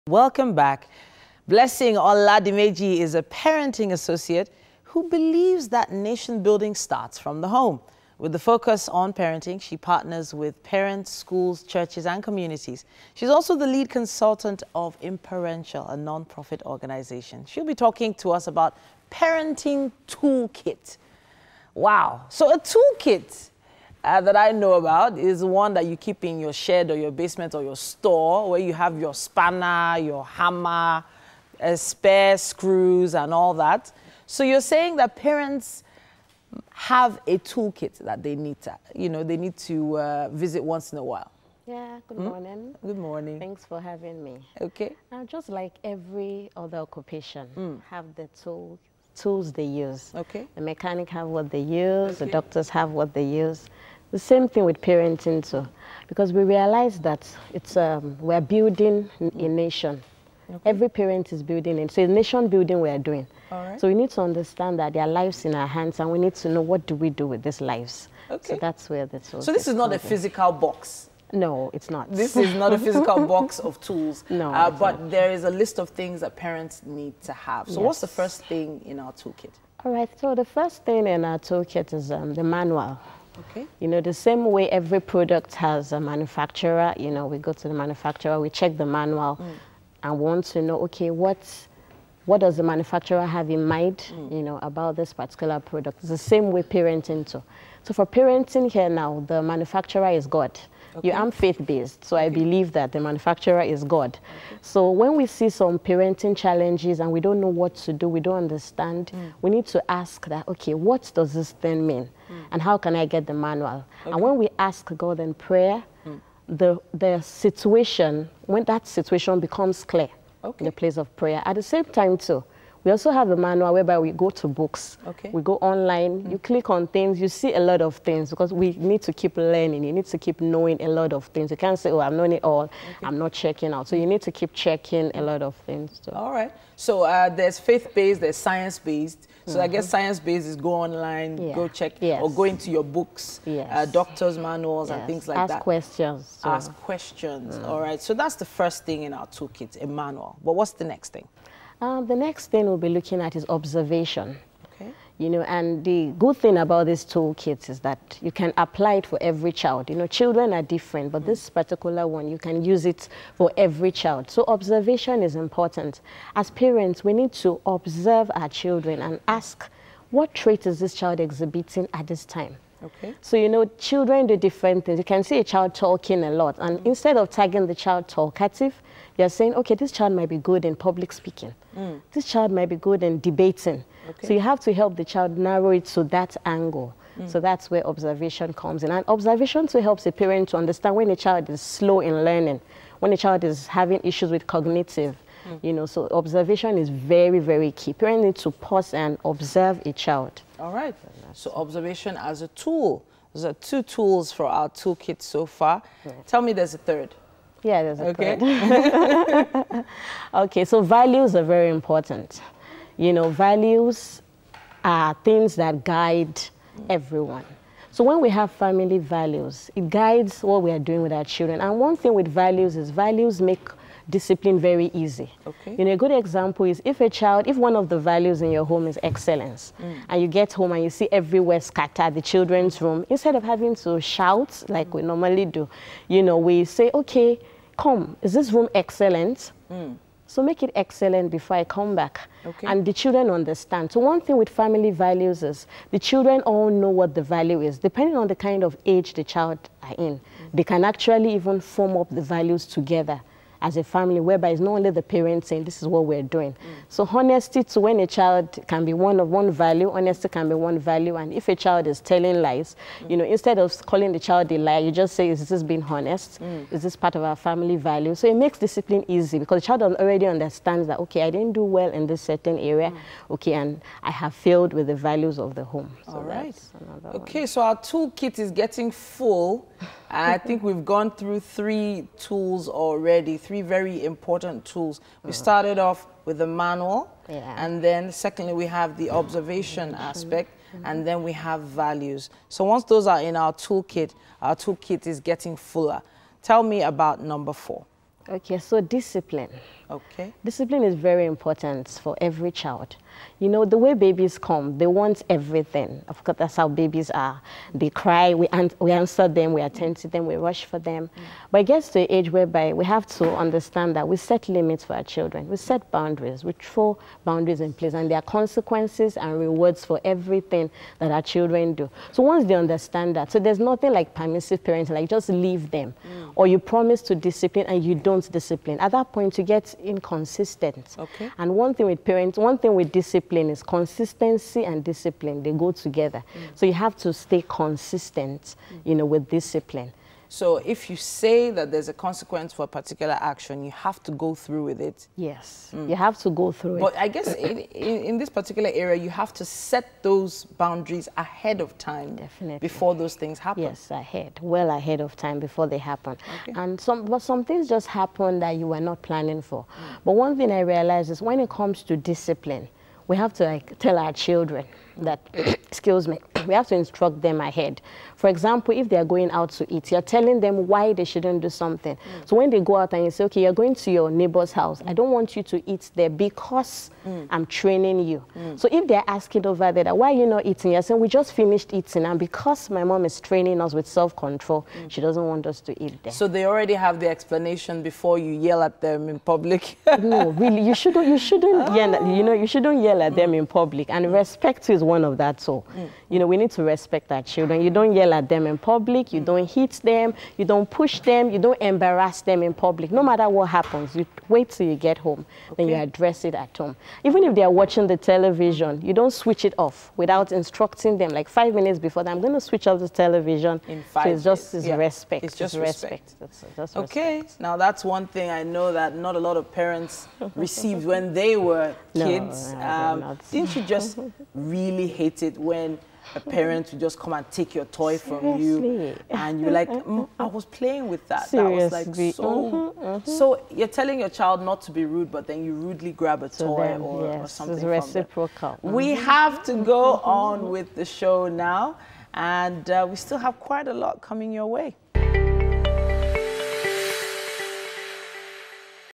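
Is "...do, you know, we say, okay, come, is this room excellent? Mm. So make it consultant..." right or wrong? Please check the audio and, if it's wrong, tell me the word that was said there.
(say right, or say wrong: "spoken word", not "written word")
wrong: "excellent", not "consultant".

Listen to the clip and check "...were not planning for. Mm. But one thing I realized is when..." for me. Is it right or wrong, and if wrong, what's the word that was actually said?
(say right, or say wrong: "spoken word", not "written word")
right.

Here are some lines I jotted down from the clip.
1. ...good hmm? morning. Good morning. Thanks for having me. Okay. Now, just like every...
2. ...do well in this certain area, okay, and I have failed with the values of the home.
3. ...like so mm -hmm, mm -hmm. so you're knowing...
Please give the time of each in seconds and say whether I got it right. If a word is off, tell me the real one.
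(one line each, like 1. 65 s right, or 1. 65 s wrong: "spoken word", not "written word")
1. 42 s right
2. 271 s right
3. 431 s wrong: "telling", not "knowing".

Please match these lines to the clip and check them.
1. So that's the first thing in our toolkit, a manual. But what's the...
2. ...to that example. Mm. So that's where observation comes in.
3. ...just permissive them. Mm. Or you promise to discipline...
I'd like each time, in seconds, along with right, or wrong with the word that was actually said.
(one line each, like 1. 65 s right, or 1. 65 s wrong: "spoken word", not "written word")
1. 148 s right
2. 185 s wrong: "angle", not "example"
3. 325 s wrong: "leave", not "permissive".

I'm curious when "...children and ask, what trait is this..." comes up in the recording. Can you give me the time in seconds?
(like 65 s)
168 s.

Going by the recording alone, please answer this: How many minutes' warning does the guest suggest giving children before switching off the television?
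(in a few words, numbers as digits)
5.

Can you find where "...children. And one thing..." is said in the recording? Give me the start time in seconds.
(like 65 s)
221 s.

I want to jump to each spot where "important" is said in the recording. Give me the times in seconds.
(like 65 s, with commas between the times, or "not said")
165 s, 211 s, 284 s, 301 s.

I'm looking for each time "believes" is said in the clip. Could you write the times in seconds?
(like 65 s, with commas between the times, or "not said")
5 s, 102 s.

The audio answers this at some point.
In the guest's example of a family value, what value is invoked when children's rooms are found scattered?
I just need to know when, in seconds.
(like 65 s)
229 s.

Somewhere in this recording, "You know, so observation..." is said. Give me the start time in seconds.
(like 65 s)
195 s.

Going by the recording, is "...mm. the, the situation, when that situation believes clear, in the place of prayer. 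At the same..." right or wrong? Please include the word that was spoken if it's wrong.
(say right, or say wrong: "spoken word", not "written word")
wrong: "becomes", not "believes".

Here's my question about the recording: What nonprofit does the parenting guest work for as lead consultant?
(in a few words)
Imparential.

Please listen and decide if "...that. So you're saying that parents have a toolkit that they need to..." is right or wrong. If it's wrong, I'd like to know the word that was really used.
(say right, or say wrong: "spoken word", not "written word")
right.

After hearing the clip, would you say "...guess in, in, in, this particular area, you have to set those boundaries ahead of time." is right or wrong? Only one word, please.
right.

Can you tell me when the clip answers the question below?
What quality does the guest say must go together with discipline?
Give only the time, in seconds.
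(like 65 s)
333 s.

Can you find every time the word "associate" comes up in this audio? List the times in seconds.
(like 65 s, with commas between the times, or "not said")
3 s.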